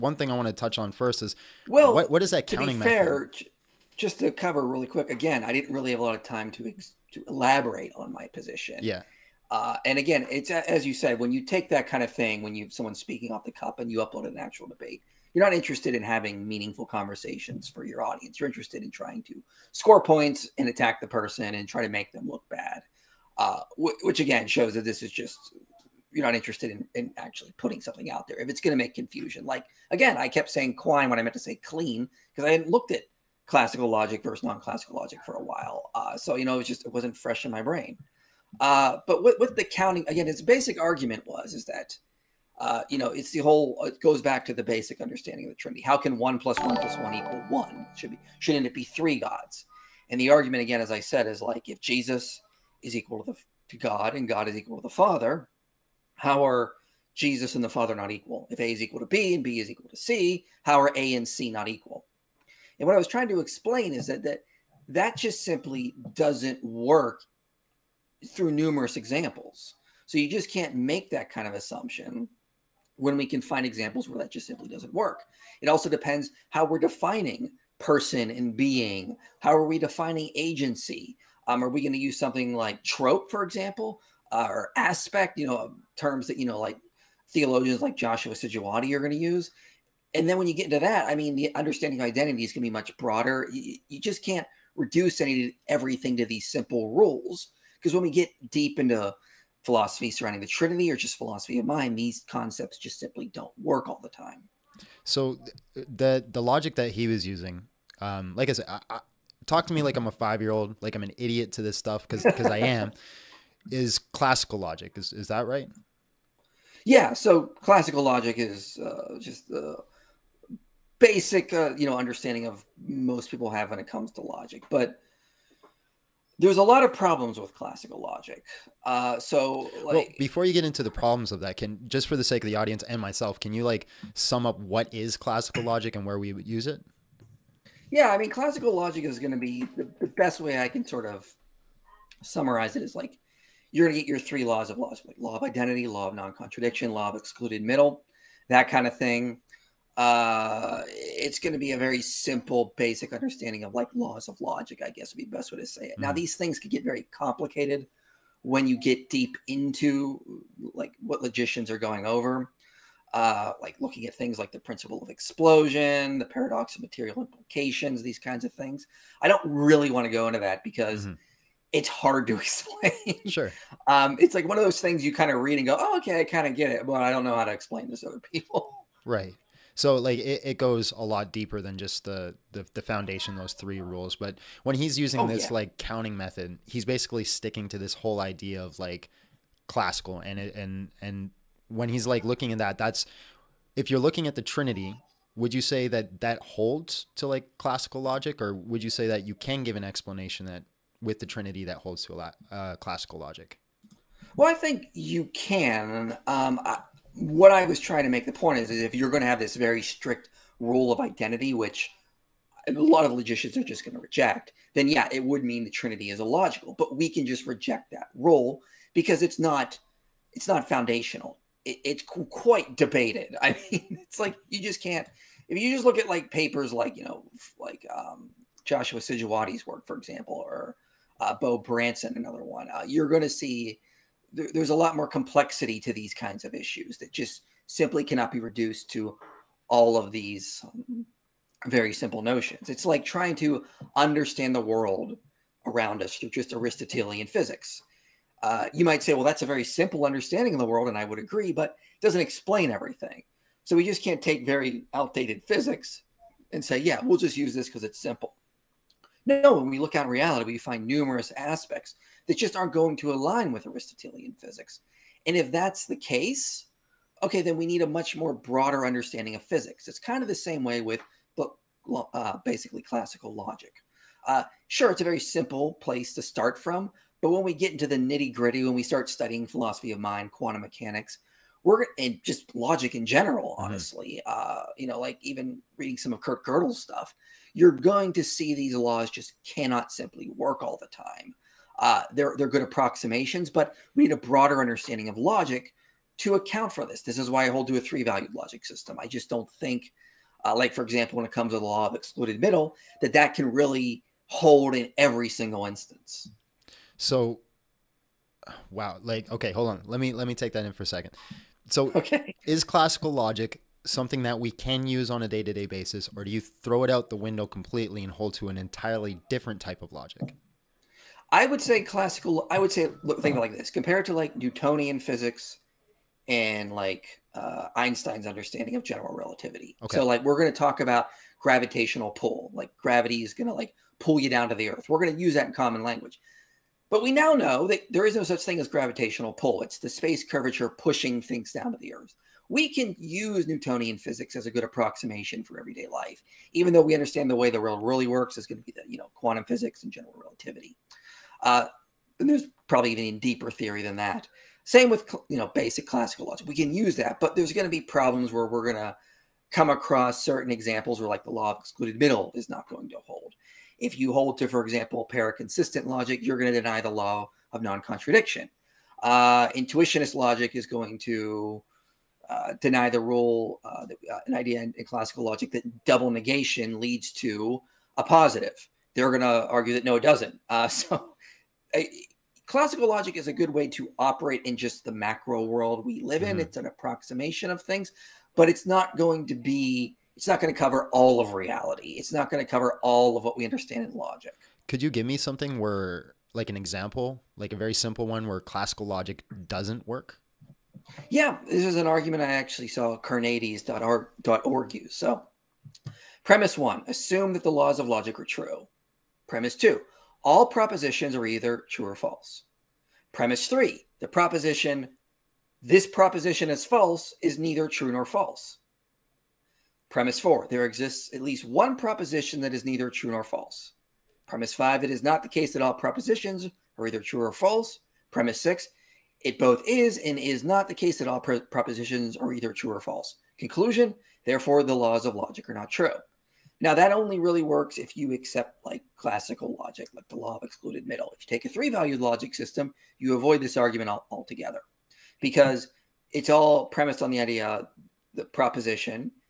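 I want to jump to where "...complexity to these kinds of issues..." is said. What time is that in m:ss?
3:55.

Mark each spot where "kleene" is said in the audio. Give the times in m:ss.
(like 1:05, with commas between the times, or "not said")
0:31.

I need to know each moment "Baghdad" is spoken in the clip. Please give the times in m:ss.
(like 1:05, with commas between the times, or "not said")
not said.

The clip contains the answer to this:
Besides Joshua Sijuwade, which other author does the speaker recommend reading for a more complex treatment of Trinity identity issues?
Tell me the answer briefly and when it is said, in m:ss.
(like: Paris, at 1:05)
Beau Branson, at 3:51.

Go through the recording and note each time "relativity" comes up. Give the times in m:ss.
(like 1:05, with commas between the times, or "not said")
5:29, 5:50.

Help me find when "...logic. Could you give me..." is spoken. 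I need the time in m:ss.
6:33.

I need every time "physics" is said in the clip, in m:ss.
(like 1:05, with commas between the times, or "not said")
4:07, 4:15, 4:24, 4:29, 5:24, 5:43, 5:49.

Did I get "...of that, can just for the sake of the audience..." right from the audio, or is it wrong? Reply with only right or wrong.
right.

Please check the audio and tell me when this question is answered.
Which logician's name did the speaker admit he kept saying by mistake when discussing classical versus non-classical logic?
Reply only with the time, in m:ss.
0:30.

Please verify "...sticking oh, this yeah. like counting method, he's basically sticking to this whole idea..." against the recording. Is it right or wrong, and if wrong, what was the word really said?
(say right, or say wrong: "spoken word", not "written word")
wrong: "using", not "sticking".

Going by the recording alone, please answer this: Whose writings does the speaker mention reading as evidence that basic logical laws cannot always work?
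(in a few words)
Kurt Gödel.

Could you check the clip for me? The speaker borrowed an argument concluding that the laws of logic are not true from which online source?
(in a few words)
Carneades.org.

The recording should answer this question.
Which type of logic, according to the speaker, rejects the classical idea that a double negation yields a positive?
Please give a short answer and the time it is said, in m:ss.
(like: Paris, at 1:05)
Intuitionist logic, at 6:09.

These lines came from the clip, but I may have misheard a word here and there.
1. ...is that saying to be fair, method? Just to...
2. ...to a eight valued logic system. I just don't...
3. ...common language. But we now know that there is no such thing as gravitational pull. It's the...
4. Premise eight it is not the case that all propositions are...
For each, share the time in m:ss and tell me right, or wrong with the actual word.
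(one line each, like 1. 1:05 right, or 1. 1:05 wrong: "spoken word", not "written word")
1. 0:02 wrong: "counting", not "saying"
2. 4:57 wrong: "three", not "eight"
3. 5:35 right
4. 7:04 wrong: "five", not "eight".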